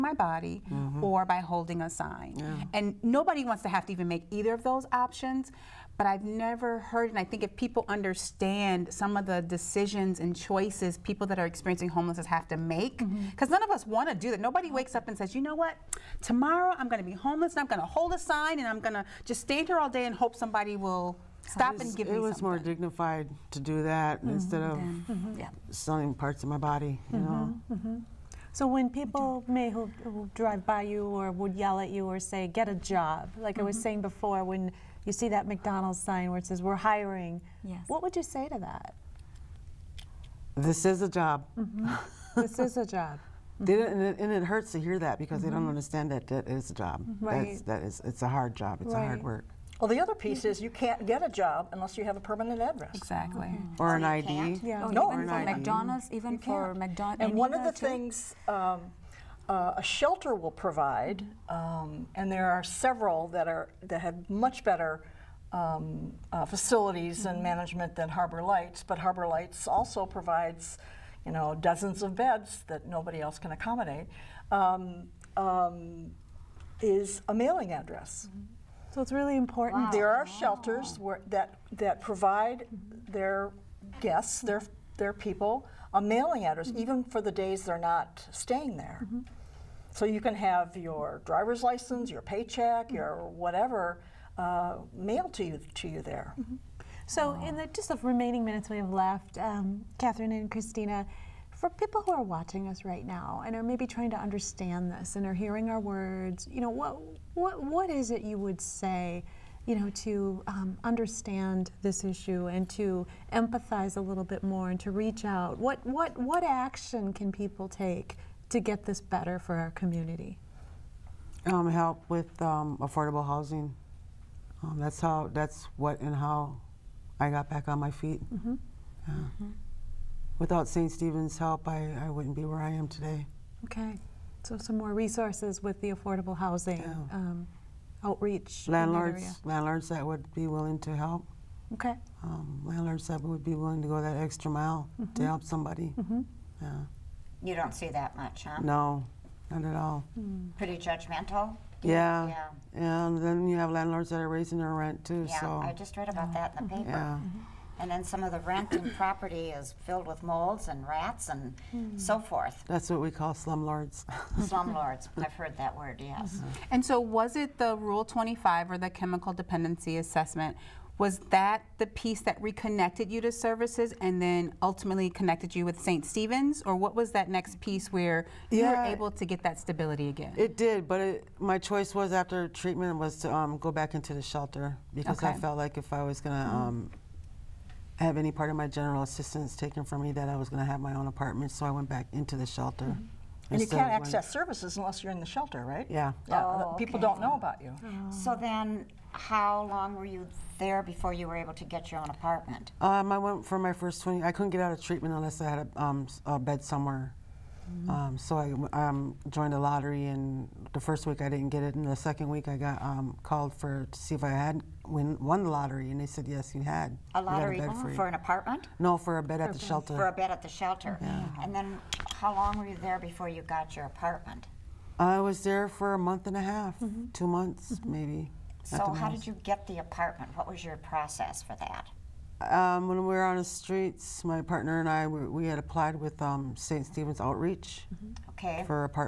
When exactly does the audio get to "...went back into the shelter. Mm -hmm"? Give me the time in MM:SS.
03:11.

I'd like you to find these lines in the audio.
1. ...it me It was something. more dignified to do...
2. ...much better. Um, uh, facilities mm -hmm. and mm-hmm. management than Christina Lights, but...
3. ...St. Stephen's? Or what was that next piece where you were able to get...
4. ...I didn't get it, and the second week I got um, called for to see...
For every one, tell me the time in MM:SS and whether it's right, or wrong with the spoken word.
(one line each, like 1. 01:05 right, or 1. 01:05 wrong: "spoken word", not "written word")
1. 00:22 right
2. 01:04 wrong: "Harbor", not "Christina"
3. 02:55 right
4. 03:31 right.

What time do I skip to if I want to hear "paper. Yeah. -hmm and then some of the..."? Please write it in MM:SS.
02:36.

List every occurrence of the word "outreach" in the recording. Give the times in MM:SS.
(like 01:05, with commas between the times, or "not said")
02:18, 03:57.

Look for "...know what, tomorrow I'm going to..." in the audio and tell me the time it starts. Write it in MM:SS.
00:15.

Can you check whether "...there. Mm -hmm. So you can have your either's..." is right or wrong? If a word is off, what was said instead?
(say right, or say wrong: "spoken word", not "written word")
wrong: "driver", not "either".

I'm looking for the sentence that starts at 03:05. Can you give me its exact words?
I felt like if I was going to mm-hmm.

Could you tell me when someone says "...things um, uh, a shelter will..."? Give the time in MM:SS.
00:57.